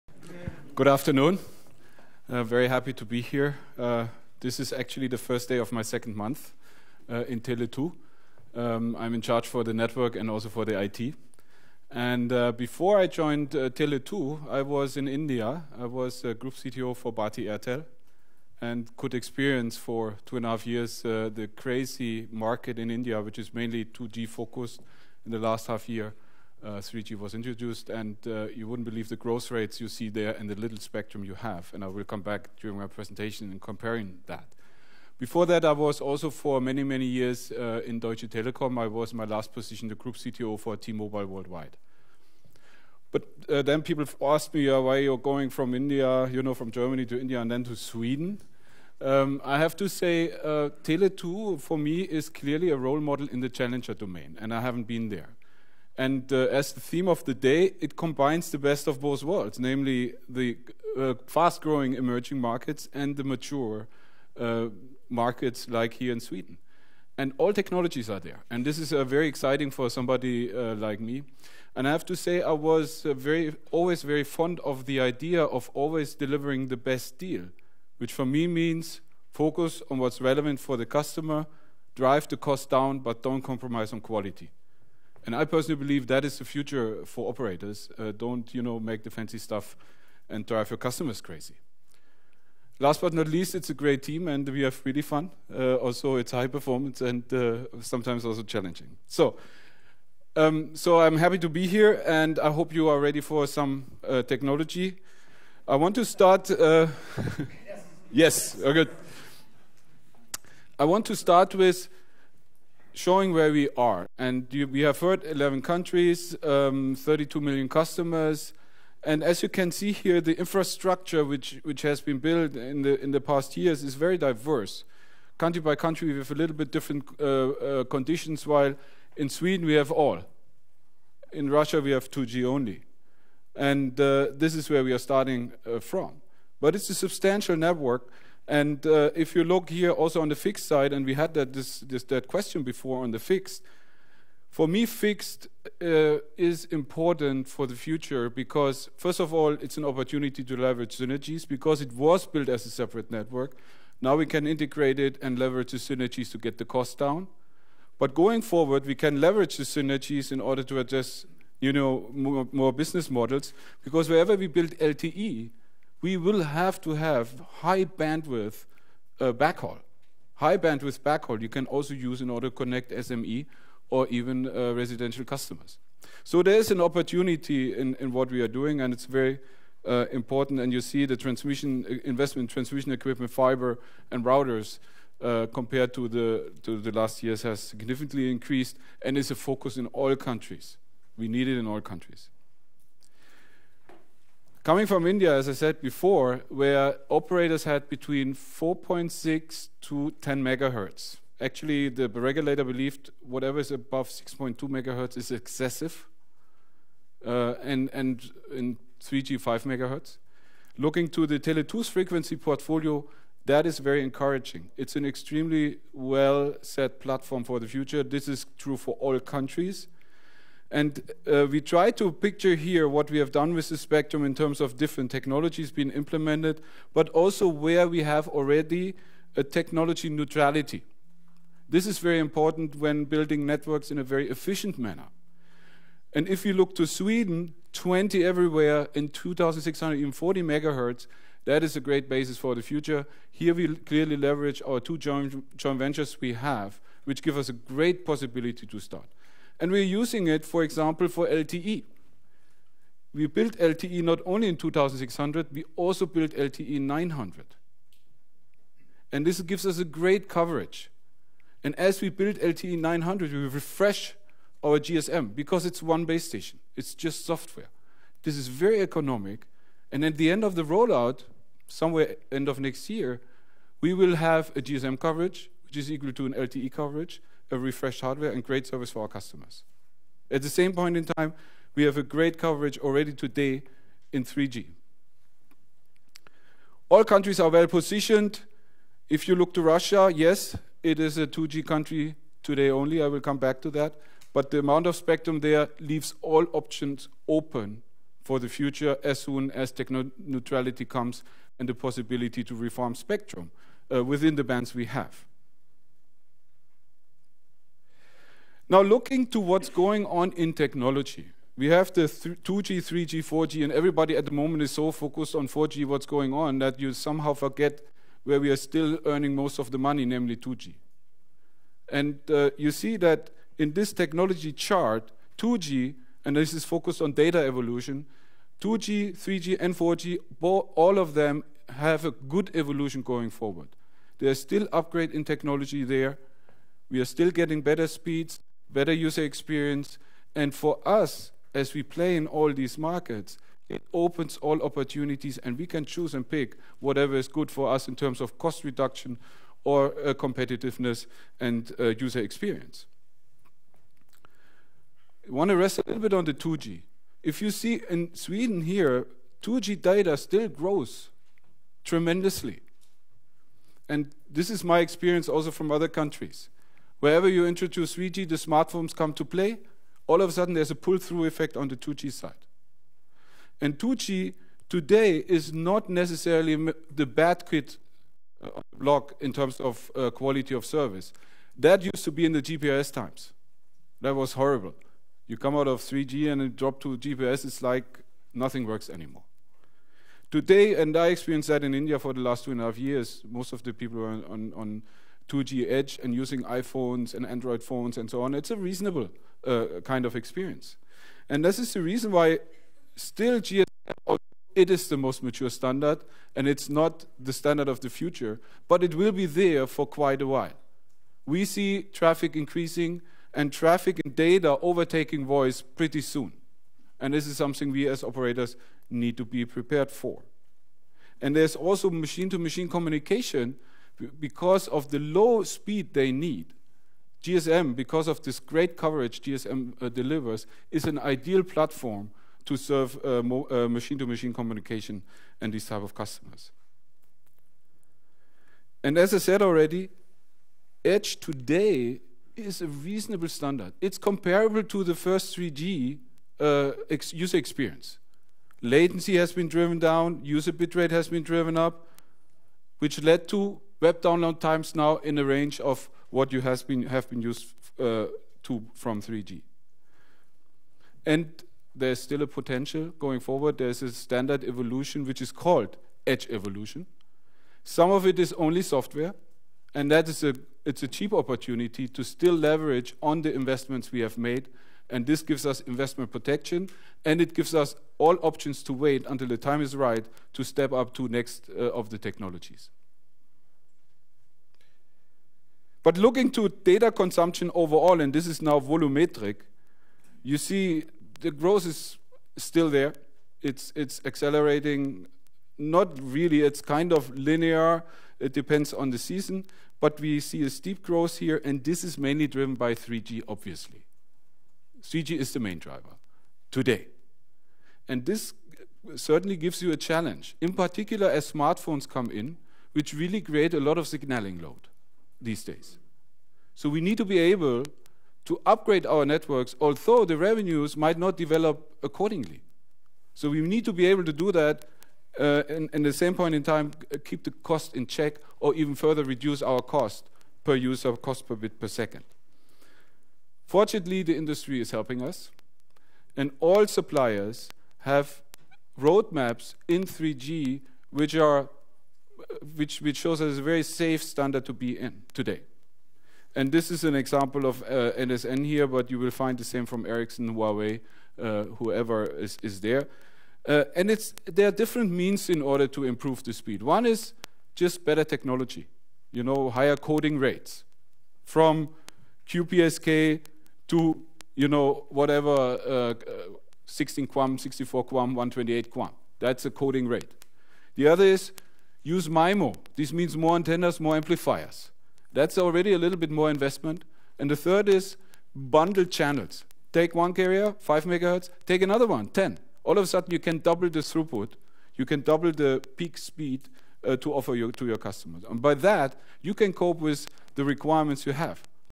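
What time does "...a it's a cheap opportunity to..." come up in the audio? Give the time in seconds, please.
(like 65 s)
470 s.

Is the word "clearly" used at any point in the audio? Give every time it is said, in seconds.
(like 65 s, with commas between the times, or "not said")
52 s, 243 s.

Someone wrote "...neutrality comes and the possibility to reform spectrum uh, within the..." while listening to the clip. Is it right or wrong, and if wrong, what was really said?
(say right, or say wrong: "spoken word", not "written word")
right.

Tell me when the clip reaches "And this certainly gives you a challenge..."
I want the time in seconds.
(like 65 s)
507 s.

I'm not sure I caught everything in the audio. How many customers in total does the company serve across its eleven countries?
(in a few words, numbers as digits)
32 million.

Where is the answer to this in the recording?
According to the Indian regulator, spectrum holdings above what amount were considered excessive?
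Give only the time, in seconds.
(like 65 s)
204 s.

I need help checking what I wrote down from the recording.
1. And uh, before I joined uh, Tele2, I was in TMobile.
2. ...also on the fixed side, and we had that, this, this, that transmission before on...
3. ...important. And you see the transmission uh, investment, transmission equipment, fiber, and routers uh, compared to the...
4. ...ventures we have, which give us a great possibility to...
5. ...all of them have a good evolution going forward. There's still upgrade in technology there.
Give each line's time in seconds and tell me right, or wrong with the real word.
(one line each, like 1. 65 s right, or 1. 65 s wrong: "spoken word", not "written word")
1. 11 s wrong: "India", not "TMobile"
2. 139 s wrong: "question", not "transmission"
3. 180 s right
4. 245 s right
5. 330 s right.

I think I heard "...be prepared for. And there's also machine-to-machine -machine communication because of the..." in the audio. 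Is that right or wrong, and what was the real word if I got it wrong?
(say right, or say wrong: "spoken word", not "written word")
right.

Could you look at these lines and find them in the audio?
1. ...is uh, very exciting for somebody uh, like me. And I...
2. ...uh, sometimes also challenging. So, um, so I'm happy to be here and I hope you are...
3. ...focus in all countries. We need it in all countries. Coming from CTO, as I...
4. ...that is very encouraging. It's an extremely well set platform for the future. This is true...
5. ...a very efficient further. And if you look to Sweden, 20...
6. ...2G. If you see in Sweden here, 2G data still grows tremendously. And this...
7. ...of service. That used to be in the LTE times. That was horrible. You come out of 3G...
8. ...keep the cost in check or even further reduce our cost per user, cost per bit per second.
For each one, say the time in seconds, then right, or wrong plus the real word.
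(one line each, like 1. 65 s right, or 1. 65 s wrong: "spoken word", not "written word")
1. 68 s right
2. 97 s right
3. 189 s wrong: "India", not "CTO"
4. 213 s right
5. 233 s wrong: "manner", not "further"
6. 356 s right
7. 380 s wrong: "GPRS", not "LTE"
8. 527 s right.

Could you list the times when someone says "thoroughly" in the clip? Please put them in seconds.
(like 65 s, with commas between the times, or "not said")
not said.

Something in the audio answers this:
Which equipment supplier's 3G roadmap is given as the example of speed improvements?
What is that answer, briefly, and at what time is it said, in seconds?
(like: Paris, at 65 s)
NSN, at 547 s.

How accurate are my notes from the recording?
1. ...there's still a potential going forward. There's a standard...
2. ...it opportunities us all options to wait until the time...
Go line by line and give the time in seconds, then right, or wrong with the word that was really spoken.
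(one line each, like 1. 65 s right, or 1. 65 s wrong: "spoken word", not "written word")
1. 461 s right
2. 477 s wrong: "gives", not "opportunities".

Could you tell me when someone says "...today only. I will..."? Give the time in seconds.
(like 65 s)
292 s.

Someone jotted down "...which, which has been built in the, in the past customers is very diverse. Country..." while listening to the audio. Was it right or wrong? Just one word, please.
wrong.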